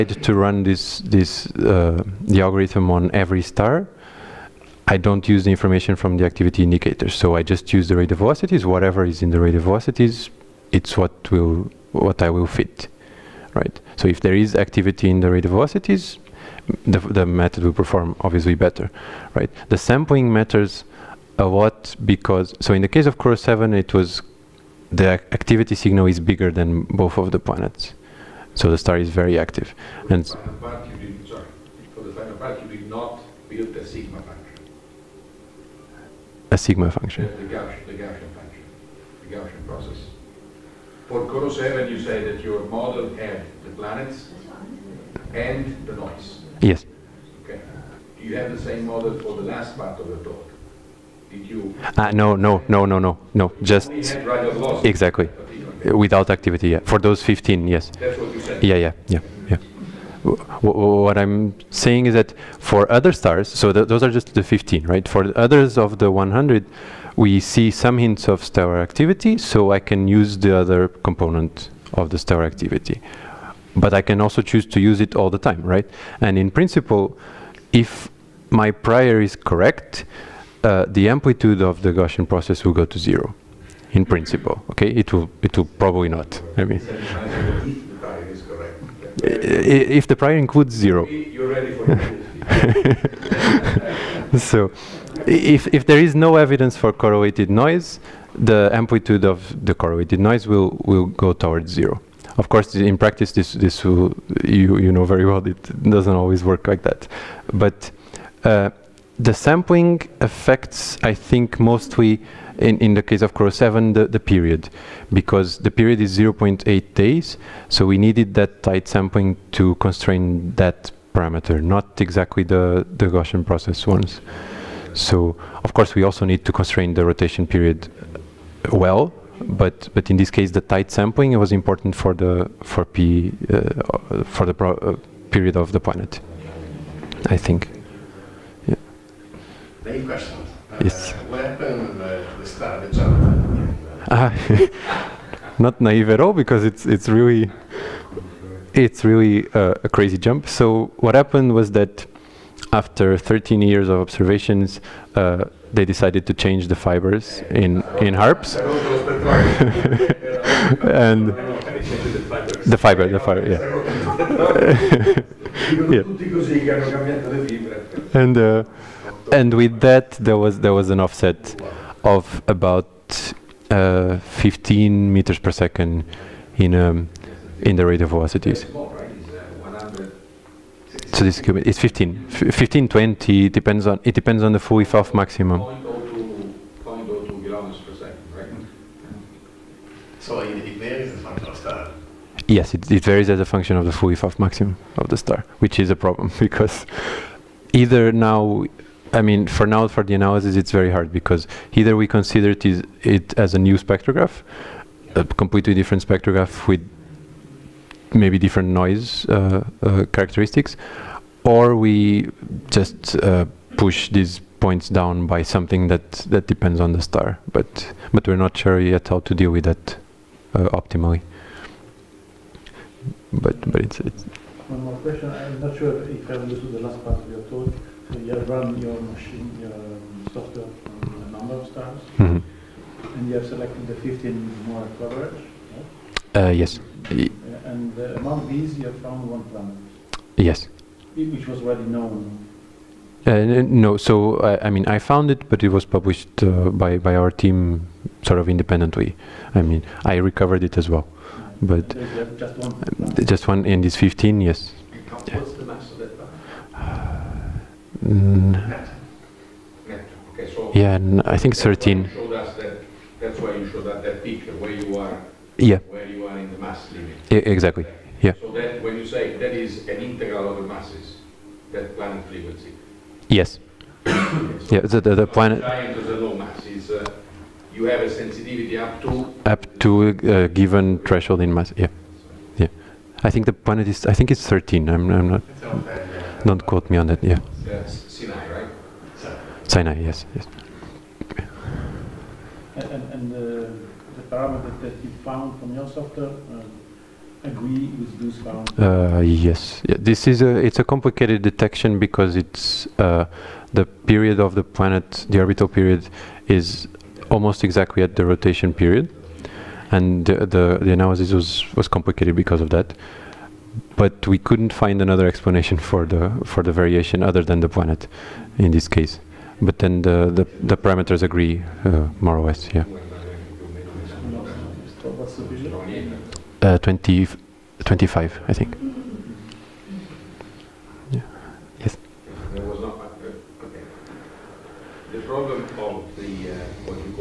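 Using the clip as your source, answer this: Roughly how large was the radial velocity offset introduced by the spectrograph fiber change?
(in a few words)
15 meters per second.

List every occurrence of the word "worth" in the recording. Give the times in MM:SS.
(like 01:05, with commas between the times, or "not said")
not said.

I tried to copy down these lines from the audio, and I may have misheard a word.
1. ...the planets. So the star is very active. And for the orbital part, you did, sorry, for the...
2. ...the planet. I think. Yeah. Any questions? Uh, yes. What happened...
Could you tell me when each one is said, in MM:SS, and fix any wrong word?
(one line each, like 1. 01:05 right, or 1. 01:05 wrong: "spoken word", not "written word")
1. 00:27 wrong: "final", not "orbital"
2. 02:15 right.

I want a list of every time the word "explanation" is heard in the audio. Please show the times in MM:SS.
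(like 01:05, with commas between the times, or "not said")
05:15.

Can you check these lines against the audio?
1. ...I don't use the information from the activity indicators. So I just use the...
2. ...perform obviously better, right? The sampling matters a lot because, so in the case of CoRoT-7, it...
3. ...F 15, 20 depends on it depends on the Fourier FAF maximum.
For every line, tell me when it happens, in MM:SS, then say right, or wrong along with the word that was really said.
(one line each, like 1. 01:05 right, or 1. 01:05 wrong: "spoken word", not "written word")
1. 00:04 right
2. 00:17 right
3. 03:02 right.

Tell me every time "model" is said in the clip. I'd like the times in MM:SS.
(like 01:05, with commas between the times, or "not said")
00:42, 00:48.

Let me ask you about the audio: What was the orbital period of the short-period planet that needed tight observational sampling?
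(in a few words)
0.8 days.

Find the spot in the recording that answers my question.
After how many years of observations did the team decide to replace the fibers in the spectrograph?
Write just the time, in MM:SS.
02:33.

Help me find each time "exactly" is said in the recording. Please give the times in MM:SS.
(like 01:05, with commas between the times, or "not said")
00:54, 02:01, 04:27, 05:07.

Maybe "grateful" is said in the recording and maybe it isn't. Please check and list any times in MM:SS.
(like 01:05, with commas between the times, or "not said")
not said.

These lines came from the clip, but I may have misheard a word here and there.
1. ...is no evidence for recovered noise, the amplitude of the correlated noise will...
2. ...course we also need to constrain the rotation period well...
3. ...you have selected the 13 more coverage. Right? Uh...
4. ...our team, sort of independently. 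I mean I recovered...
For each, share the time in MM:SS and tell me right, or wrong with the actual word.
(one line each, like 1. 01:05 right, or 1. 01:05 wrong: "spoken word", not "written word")
1. 01:35 wrong: "correlated", not "recovered"
2. 02:05 right
3. 03:53 wrong: "15", not "13"
4. 04:07 right.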